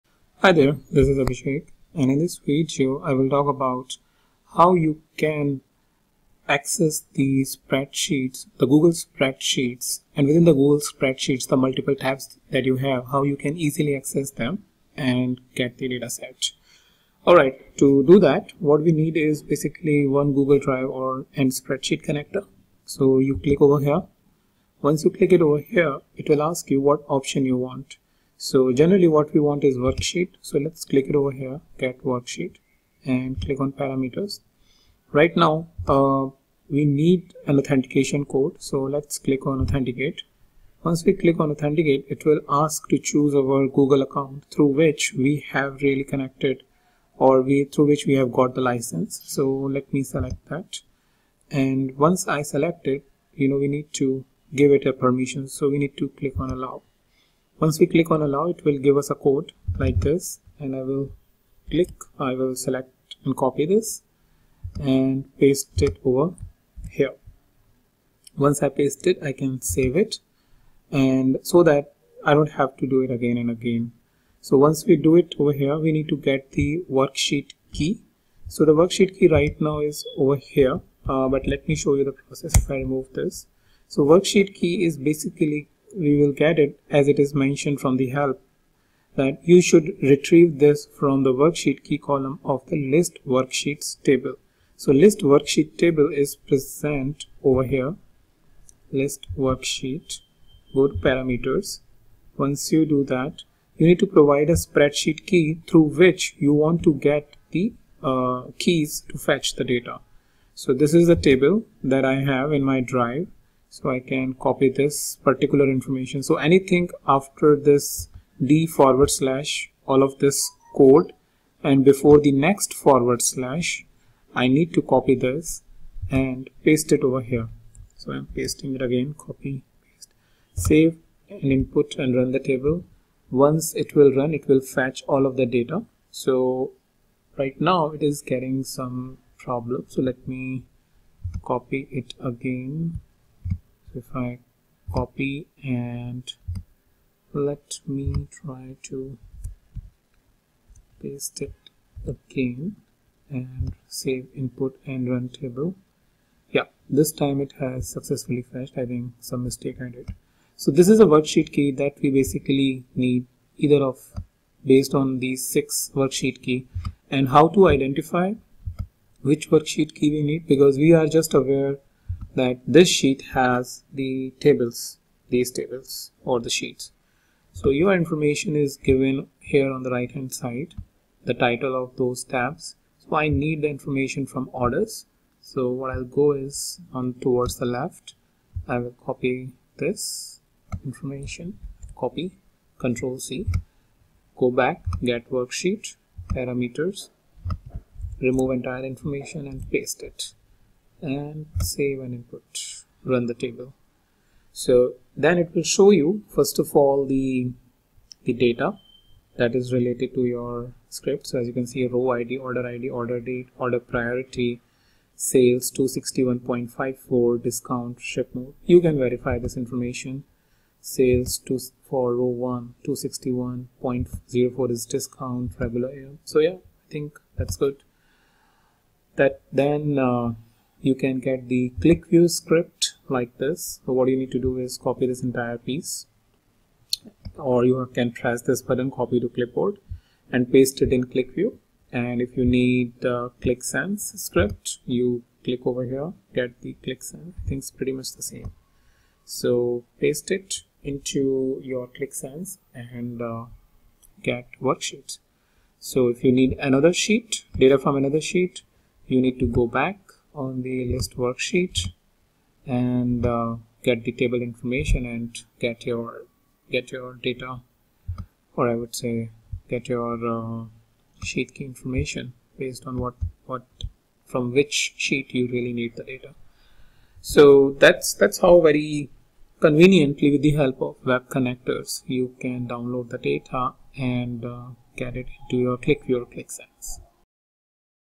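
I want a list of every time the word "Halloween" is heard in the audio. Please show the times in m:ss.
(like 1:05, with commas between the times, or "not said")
not said.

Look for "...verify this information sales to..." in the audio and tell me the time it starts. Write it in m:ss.
3:39.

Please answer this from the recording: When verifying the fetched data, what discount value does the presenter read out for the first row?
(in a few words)
regular.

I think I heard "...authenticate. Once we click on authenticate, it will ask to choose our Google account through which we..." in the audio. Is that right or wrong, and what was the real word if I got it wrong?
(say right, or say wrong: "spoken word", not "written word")
right.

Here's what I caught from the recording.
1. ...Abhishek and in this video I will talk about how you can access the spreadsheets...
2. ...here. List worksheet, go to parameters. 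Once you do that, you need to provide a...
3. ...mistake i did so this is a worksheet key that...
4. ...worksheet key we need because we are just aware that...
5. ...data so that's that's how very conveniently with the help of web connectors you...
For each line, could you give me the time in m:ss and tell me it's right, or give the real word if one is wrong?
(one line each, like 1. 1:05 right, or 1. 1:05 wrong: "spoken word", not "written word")
1. 0:01 right
2. 1:37 right
3. 2:39 right
4. 2:49 right
5. 4:36 right.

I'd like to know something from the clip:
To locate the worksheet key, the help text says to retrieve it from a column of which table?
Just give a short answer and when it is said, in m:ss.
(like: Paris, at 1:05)
list worksheets table, at 1:32.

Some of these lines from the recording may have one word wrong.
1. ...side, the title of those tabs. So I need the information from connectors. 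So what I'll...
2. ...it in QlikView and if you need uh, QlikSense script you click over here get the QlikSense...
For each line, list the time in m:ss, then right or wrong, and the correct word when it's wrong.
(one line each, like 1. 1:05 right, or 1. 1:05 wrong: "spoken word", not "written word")
1. 3:00 wrong: "orders", not "connectors"
2. 4:00 right.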